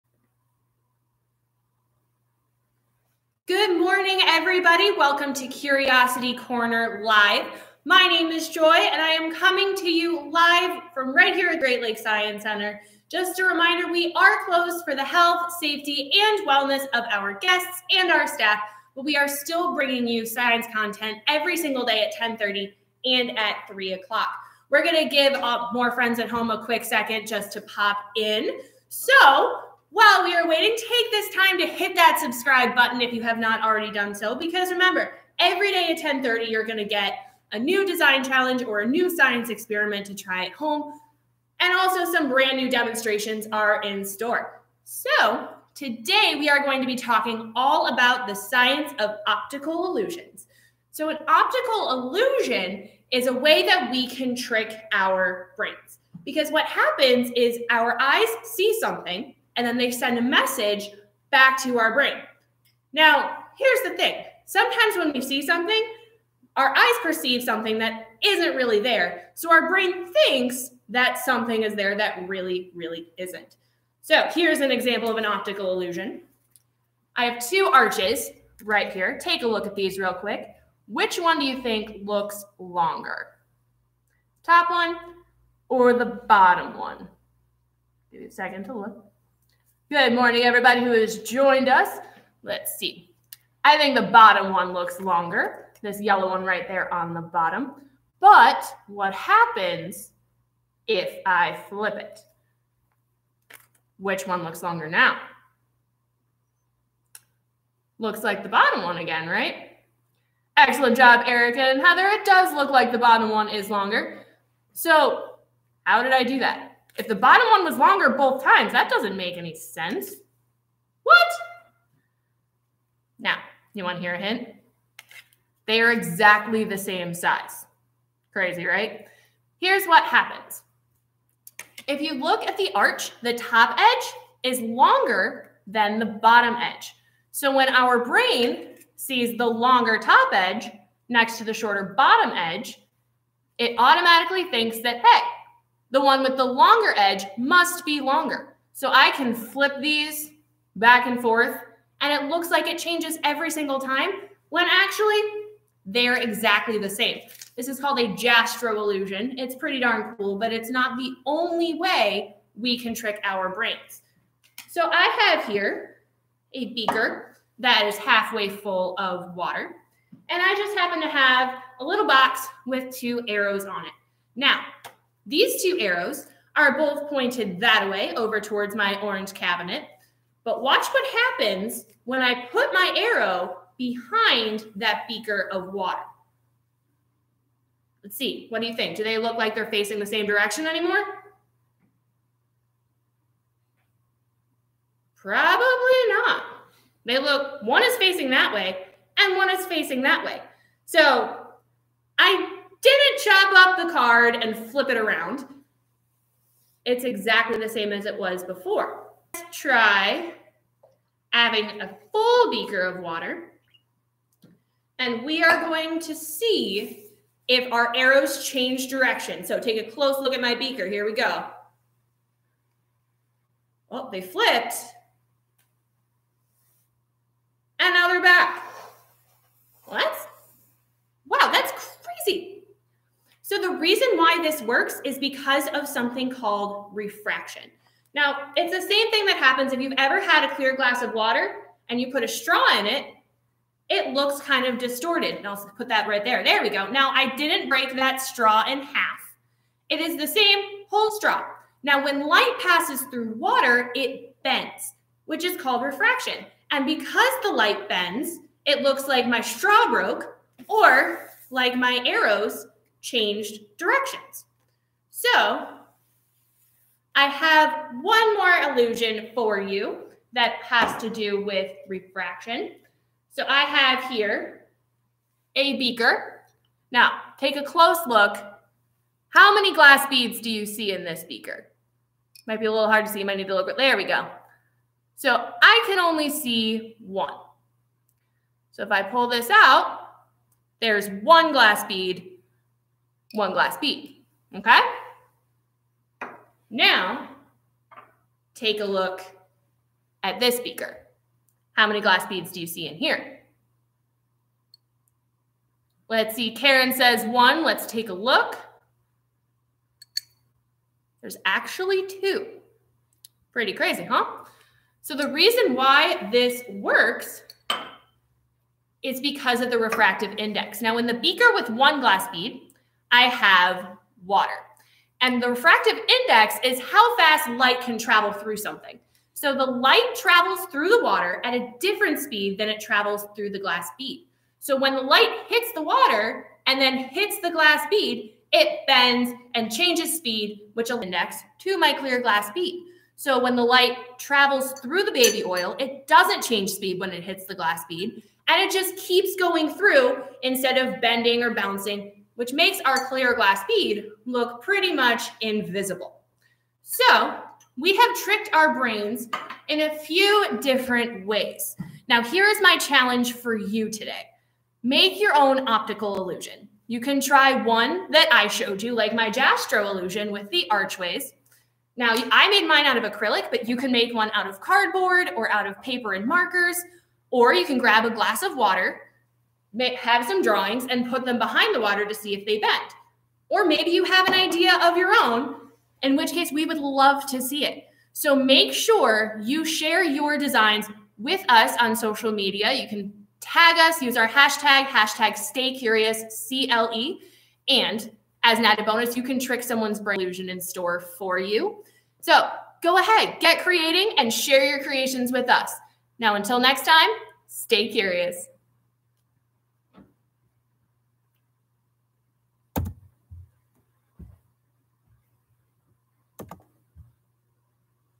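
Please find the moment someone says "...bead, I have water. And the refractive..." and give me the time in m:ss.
5:22.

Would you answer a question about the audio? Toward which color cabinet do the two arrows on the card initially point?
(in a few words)
Orange.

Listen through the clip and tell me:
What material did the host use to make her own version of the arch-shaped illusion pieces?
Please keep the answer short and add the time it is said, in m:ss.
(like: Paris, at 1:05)
Acrylic, at 6:13.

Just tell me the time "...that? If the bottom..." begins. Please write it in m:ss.
1:56.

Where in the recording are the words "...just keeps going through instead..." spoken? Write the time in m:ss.
5:48.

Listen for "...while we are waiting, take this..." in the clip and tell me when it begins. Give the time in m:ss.
0:29.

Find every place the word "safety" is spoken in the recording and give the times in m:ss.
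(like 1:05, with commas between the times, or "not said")
0:15.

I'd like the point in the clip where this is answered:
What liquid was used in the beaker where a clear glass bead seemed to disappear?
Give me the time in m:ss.
5:45.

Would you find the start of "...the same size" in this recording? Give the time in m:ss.
2:06.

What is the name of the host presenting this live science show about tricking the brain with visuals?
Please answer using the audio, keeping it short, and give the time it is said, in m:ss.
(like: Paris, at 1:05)
Joy, at 0:08.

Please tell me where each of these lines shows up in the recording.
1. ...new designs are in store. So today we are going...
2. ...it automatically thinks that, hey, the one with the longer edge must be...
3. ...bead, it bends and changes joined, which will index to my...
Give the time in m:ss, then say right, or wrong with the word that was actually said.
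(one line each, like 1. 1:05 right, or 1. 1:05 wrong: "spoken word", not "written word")
1. 0:42 wrong: "demonstrations", not "designs"
2. 2:23 right
3. 5:37 wrong: "speed", not "joined".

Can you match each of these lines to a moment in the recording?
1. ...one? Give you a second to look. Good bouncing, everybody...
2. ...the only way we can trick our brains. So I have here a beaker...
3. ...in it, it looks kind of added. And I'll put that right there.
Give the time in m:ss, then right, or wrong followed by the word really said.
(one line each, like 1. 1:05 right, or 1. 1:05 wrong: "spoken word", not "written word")
1. 1:26 wrong: "morning", not "bouncing"
2. 2:40 right
3. 4:02 wrong: "distorted", not "added".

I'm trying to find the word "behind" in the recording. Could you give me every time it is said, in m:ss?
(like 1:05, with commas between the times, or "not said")
3:03, 6:21.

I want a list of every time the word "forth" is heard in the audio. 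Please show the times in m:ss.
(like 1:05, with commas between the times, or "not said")
2:31.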